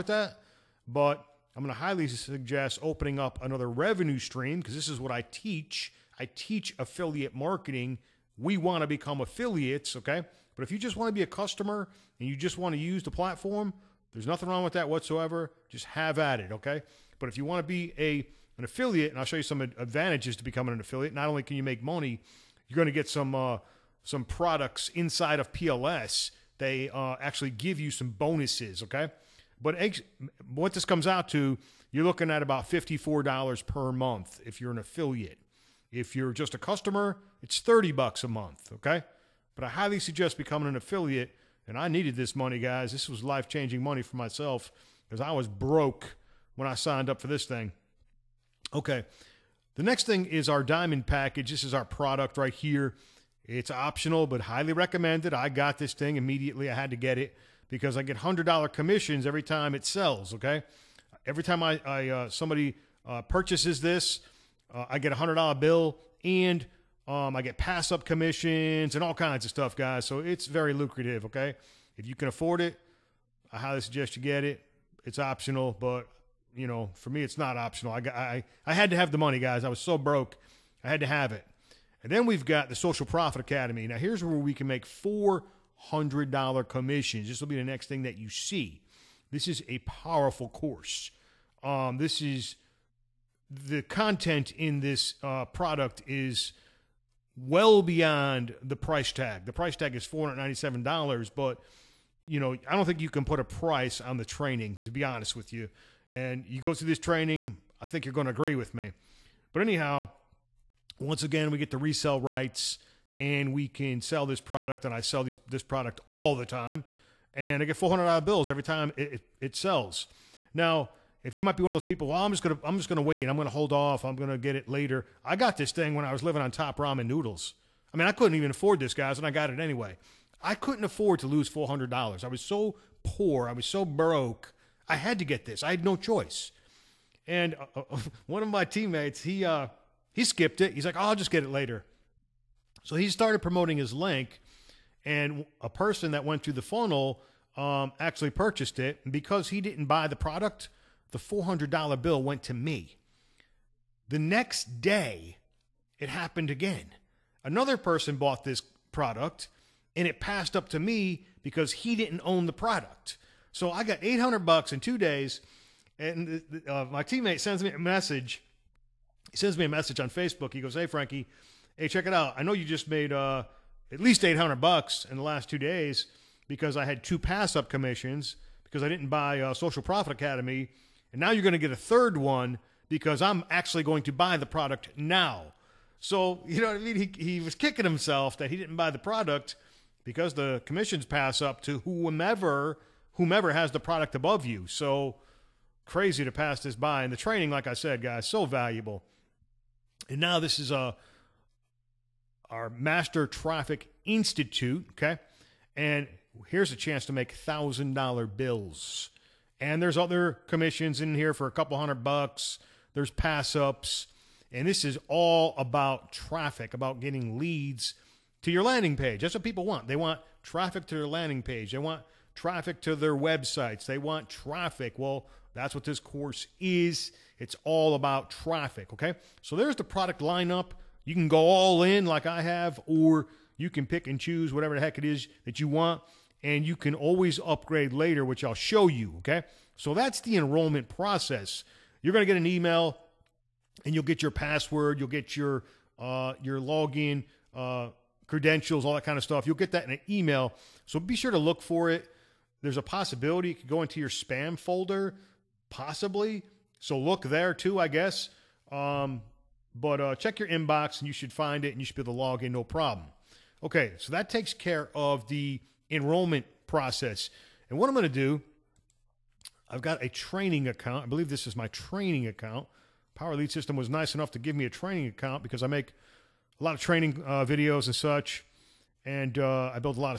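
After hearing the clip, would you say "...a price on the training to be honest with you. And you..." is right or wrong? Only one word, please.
right.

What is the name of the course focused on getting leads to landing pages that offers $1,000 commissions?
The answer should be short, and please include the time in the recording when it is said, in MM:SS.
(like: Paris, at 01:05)
Master Traffic Institute, at 03:22.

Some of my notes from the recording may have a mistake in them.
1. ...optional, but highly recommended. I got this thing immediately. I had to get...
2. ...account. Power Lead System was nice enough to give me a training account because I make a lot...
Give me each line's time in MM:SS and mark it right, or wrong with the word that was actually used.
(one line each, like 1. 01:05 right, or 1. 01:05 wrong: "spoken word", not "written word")
1. 00:53 right
2. 04:32 right.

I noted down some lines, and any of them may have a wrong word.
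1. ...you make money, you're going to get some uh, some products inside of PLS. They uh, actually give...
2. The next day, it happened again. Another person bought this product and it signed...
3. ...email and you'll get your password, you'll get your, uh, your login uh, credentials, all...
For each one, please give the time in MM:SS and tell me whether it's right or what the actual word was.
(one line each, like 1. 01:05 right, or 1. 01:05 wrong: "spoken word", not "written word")
1. 00:21 right
2. 02:34 wrong: "passed", not "signed"
3. 04:02 right.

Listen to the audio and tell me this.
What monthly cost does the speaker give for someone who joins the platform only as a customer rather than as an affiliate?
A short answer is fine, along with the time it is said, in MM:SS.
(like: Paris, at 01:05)
$30, at 00:37.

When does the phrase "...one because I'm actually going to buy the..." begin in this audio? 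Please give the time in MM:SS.
03:02.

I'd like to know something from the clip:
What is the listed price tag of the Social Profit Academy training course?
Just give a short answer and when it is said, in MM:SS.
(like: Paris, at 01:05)
$497, at 01:40.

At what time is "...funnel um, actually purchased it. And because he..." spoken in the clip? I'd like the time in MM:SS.
02:26.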